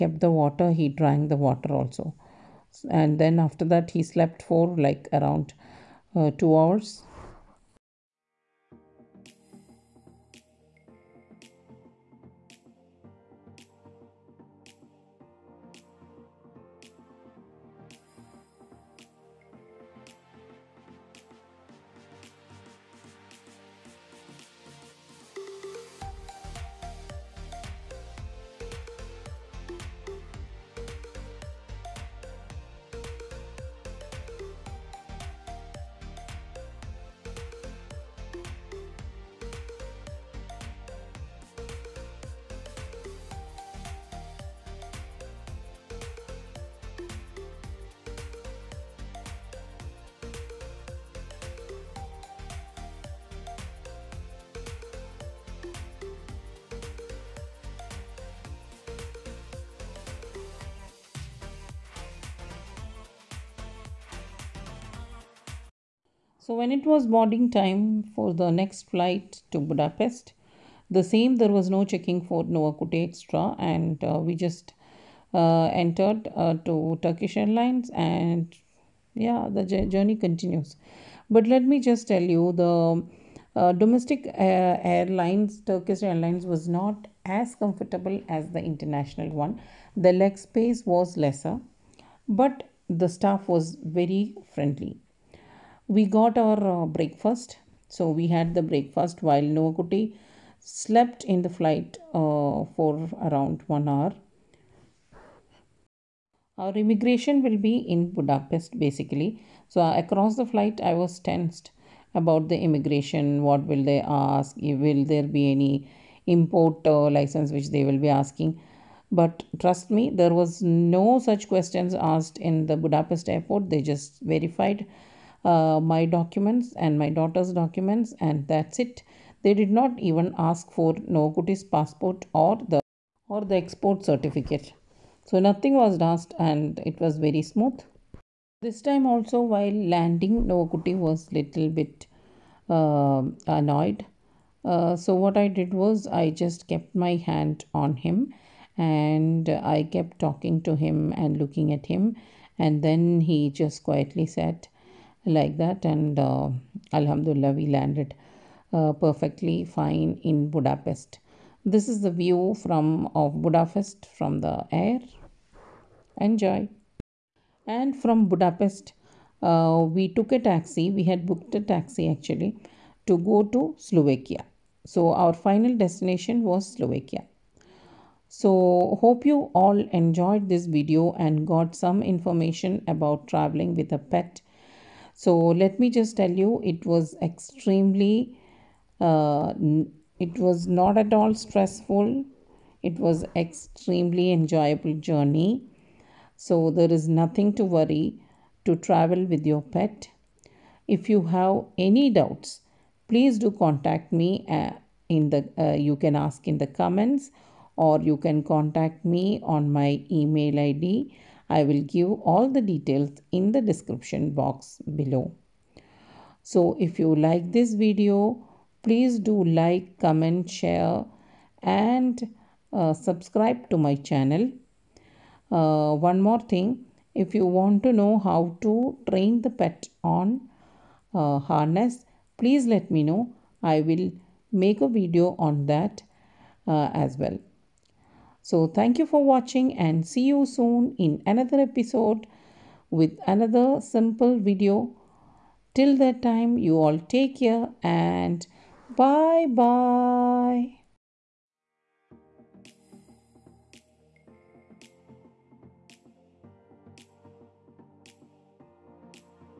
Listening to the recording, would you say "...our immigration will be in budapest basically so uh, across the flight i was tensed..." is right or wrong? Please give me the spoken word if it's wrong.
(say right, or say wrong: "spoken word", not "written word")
right.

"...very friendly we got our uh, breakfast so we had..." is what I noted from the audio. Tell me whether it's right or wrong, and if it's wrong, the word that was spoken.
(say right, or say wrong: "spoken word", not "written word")
right.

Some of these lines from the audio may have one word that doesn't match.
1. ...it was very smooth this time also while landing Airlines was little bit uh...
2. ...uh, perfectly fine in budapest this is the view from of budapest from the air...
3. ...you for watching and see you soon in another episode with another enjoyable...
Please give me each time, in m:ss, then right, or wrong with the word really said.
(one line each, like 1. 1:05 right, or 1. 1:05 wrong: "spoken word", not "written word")
1. 2:16 wrong: "Noakutty", not "Airlines"
2. 2:38 right
3. 3:58 wrong: "simple", not "enjoyable".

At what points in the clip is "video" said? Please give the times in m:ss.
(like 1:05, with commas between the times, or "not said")
3:00, 3:37, 3:54, 4:04.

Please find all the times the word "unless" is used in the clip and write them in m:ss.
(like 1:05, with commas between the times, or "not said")
not said.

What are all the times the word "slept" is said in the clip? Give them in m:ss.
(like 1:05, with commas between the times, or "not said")
0:04, 1:40.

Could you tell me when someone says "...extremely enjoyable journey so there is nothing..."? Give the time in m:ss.
3:13.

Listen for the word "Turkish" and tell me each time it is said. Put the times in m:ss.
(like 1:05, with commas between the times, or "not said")
1:17, 1:25.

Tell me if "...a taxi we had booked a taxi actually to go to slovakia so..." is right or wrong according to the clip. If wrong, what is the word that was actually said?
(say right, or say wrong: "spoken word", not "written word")
right.